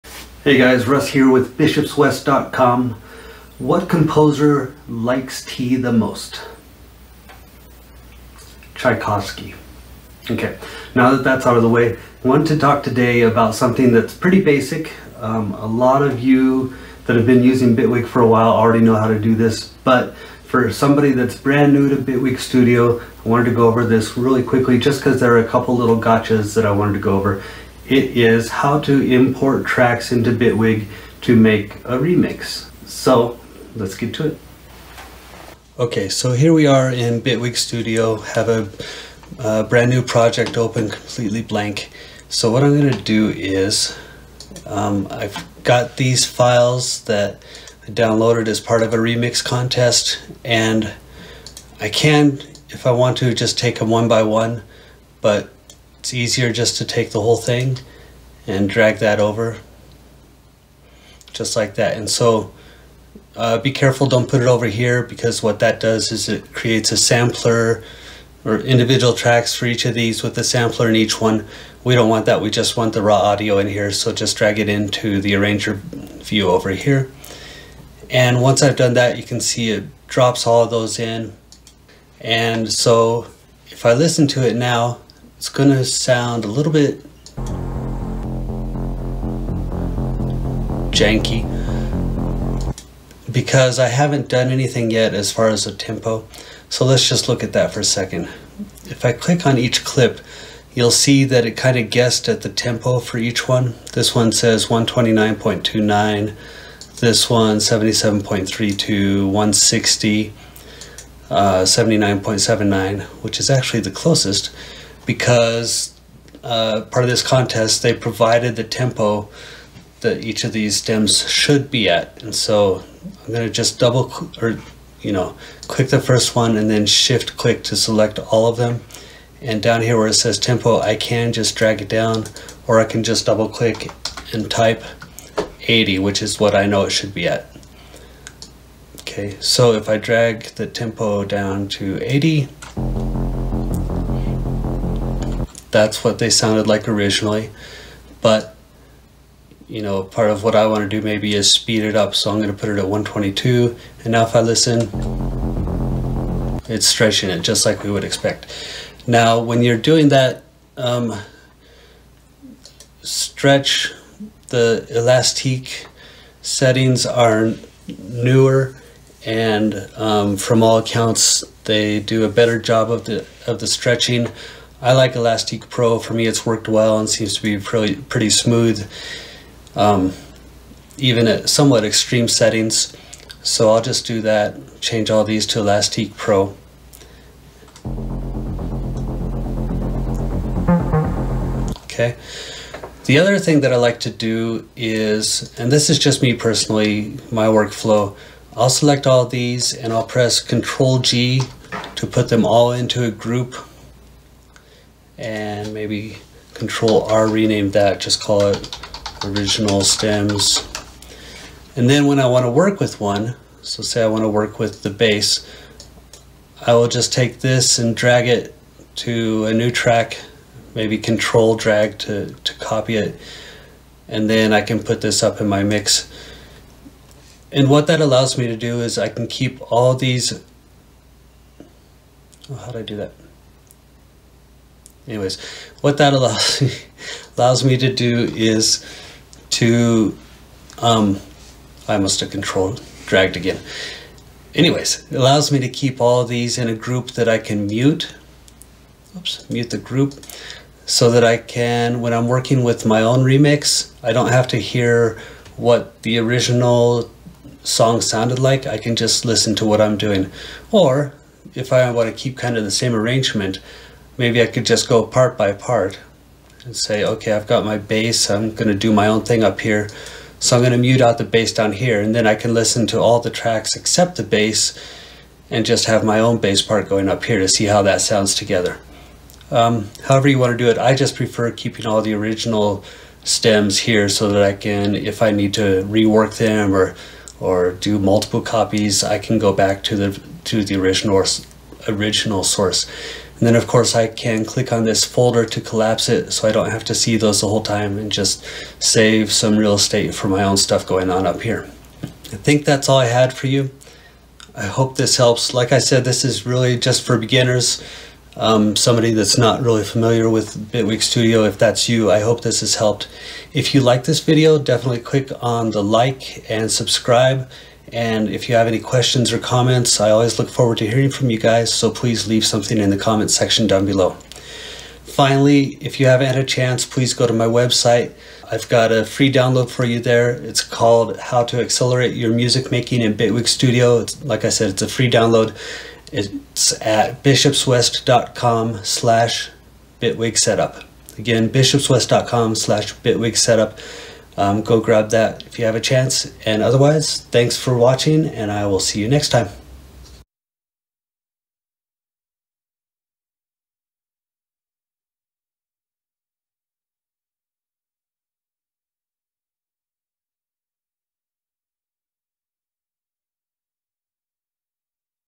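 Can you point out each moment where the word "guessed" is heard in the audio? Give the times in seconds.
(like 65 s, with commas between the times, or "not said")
101 s.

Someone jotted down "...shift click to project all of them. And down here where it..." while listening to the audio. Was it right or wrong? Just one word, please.
wrong.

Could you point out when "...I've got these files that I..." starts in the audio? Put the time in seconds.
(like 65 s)
45 s.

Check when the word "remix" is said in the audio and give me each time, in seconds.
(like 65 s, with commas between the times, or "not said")
31 s, 48 s, 253 s.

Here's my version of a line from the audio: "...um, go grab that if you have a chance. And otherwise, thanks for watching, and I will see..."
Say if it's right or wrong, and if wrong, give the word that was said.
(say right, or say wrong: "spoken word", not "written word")
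right.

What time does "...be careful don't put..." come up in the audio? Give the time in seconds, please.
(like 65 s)
63 s.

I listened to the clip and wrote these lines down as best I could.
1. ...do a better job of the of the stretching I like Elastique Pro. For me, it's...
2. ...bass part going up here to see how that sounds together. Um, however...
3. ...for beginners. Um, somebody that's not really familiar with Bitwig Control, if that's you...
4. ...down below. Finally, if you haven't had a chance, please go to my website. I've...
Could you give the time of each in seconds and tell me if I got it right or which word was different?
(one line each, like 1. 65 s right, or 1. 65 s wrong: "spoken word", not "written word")
1. 171 s right
2. 276 s right
3. 307 s wrong: "Studio", not "Control"
4. 323 s right.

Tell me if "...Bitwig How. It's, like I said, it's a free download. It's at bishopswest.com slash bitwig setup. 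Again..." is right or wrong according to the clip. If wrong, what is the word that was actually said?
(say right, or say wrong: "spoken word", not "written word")
wrong: "Studio", not "How".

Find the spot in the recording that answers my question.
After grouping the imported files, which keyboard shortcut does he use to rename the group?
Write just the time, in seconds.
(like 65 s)
206 s.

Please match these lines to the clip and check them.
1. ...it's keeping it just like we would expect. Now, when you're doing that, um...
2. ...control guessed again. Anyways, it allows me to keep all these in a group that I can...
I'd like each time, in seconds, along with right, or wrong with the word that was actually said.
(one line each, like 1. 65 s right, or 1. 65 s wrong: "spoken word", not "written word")
1. 156 s wrong: "stretching", not "keeping"
2. 242 s wrong: "dragged", not "guessed".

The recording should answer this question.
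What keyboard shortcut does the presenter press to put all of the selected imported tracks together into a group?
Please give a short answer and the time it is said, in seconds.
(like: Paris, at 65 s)
Control G, at 200 s.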